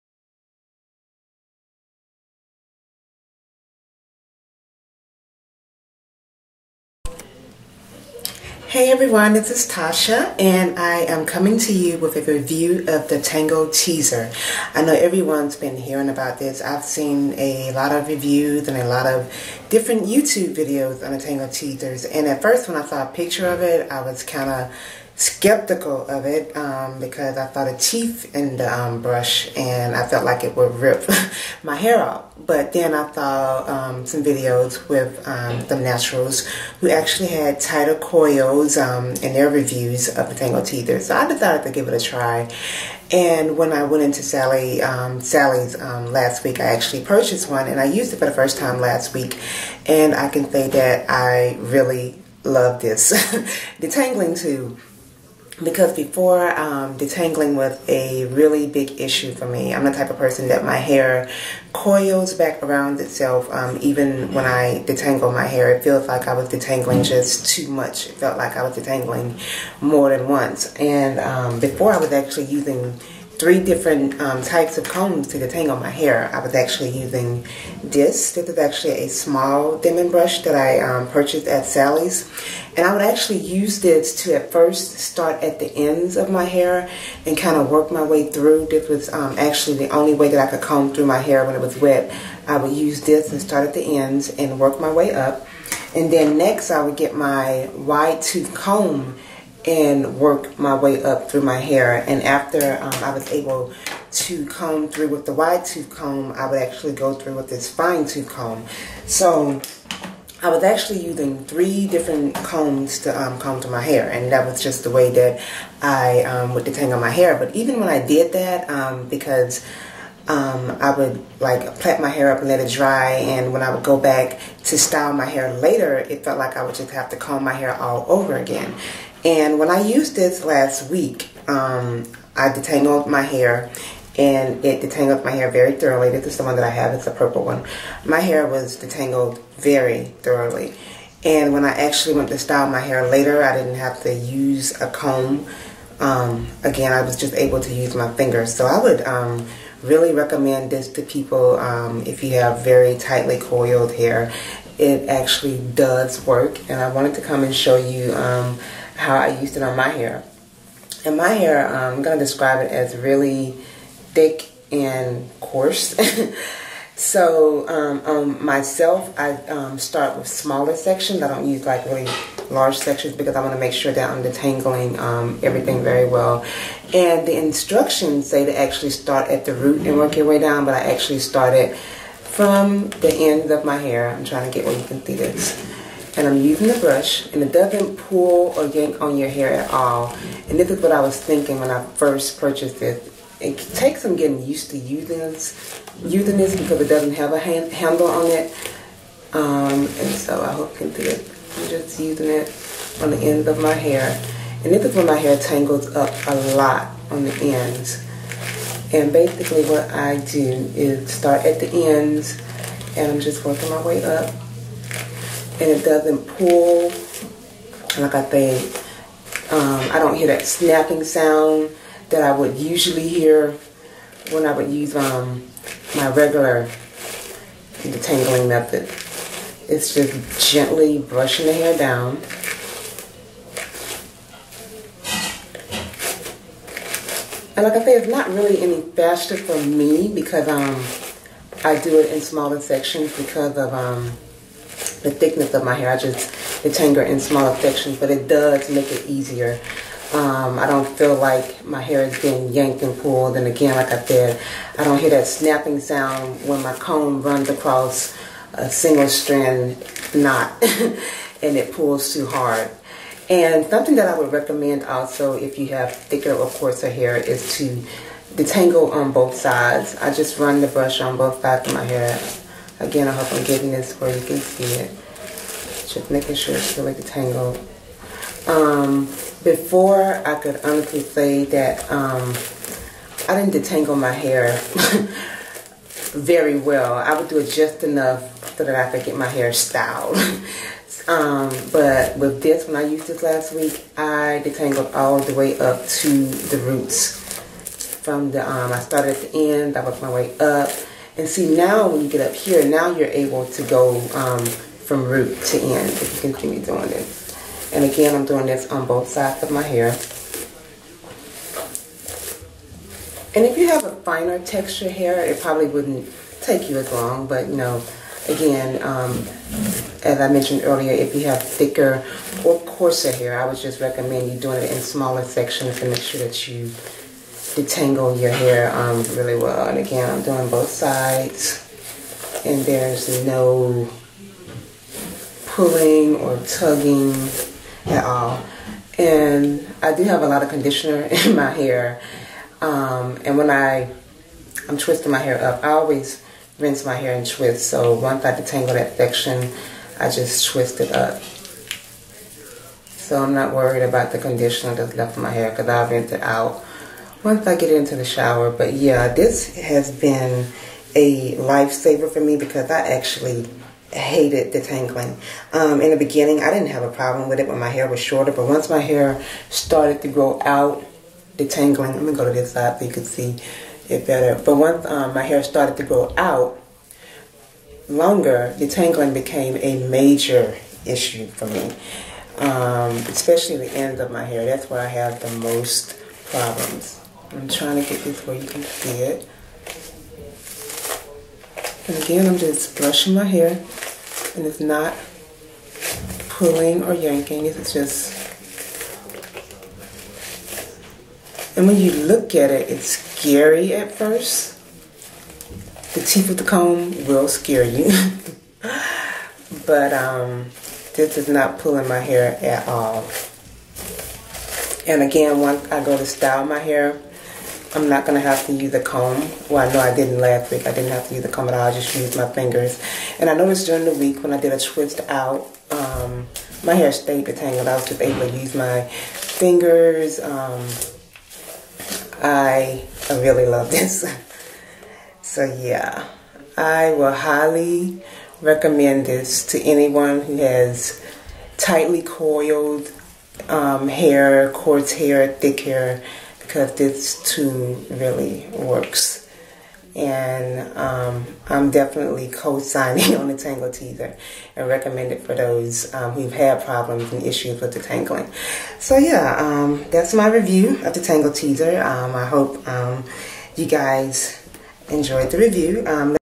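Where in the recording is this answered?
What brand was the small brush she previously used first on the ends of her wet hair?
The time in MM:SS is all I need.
01:19.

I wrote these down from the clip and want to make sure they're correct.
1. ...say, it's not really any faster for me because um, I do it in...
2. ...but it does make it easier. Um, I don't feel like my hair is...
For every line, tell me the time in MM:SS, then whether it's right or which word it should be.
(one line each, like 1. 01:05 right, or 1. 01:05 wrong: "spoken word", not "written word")
1. 03:57 right
2. 04:07 right.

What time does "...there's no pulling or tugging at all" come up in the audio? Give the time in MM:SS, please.
05:32.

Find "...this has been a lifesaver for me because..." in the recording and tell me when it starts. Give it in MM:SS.
05:59.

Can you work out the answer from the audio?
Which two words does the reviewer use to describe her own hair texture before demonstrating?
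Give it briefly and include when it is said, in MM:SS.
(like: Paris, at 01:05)
Thick and coarse, at 02:44.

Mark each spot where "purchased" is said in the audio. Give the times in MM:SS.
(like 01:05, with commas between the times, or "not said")
00:47, 01:21, 03:12.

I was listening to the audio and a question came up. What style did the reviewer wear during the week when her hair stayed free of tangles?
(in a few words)
Twist out.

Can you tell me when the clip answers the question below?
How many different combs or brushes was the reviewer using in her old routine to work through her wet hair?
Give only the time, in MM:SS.
01:13.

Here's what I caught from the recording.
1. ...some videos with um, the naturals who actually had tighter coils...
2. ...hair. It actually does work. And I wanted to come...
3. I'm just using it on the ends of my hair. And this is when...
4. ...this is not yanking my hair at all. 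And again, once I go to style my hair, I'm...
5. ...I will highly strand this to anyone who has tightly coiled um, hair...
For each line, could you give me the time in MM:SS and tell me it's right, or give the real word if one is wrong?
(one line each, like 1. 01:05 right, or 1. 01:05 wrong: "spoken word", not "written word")
1. 00:34 right
2. 02:33 right
3. 03:21 right
4. 06:50 wrong: "pulling", not "yanking"
5. 07:16 wrong: "recommend", not "strand".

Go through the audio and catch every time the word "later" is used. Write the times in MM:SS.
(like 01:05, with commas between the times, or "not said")
02:05, 02:23.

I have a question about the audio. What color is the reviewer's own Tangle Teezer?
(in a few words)
Purple.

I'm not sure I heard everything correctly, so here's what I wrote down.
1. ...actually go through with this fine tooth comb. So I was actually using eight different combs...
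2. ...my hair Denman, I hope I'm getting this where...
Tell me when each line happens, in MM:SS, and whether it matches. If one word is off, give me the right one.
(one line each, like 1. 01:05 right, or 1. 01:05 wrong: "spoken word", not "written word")
1. 01:46 wrong: "three", not "eight"
2. 04:31 wrong: "Again", not "Denman".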